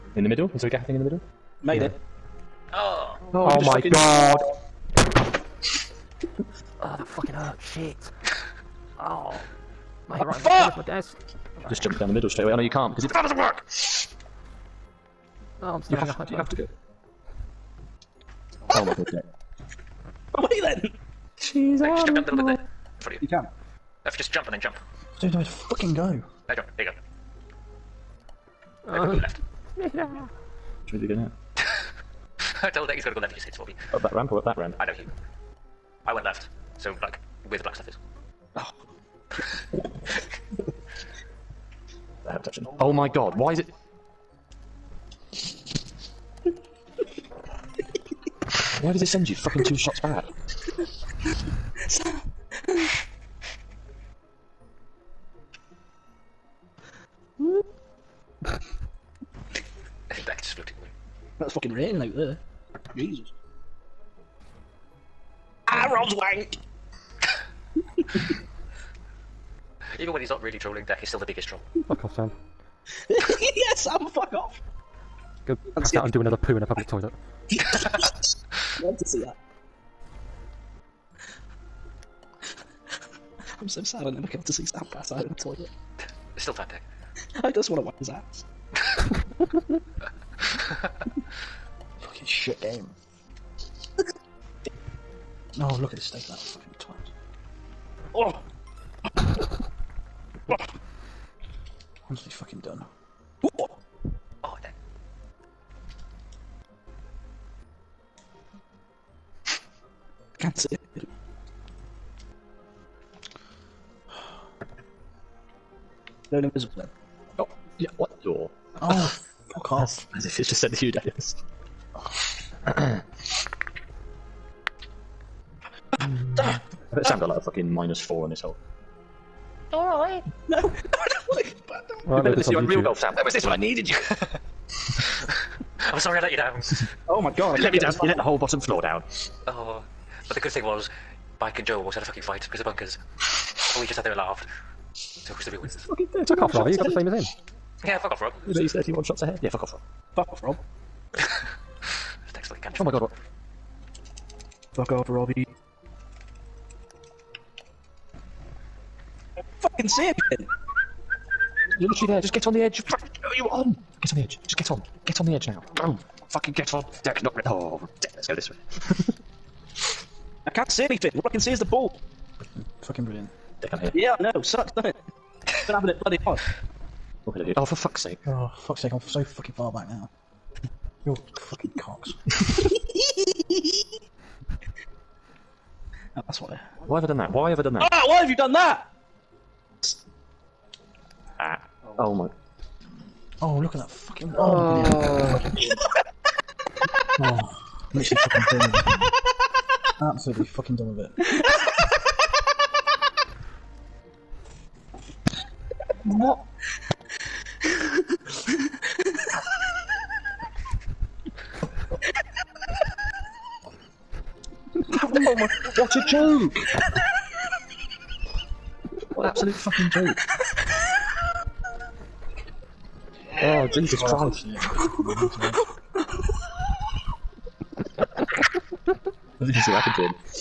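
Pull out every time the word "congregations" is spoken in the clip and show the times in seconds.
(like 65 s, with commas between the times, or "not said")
not said.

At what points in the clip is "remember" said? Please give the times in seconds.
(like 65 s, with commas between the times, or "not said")
132 s.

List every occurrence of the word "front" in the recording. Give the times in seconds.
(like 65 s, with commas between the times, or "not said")
23 s.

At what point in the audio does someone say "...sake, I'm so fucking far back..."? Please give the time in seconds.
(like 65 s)
178 s.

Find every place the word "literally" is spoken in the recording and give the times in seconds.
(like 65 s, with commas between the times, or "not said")
161 s, 197 s.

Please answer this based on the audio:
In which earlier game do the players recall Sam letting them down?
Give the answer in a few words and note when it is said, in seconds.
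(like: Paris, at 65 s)
Real Golf, at 132 s.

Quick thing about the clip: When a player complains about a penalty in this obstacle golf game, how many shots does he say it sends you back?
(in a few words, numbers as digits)
2.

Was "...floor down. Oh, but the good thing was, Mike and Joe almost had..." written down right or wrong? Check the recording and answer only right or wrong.
right.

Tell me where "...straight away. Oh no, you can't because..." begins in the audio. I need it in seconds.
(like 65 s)
12 s.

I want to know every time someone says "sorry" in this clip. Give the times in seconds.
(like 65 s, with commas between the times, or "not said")
135 s.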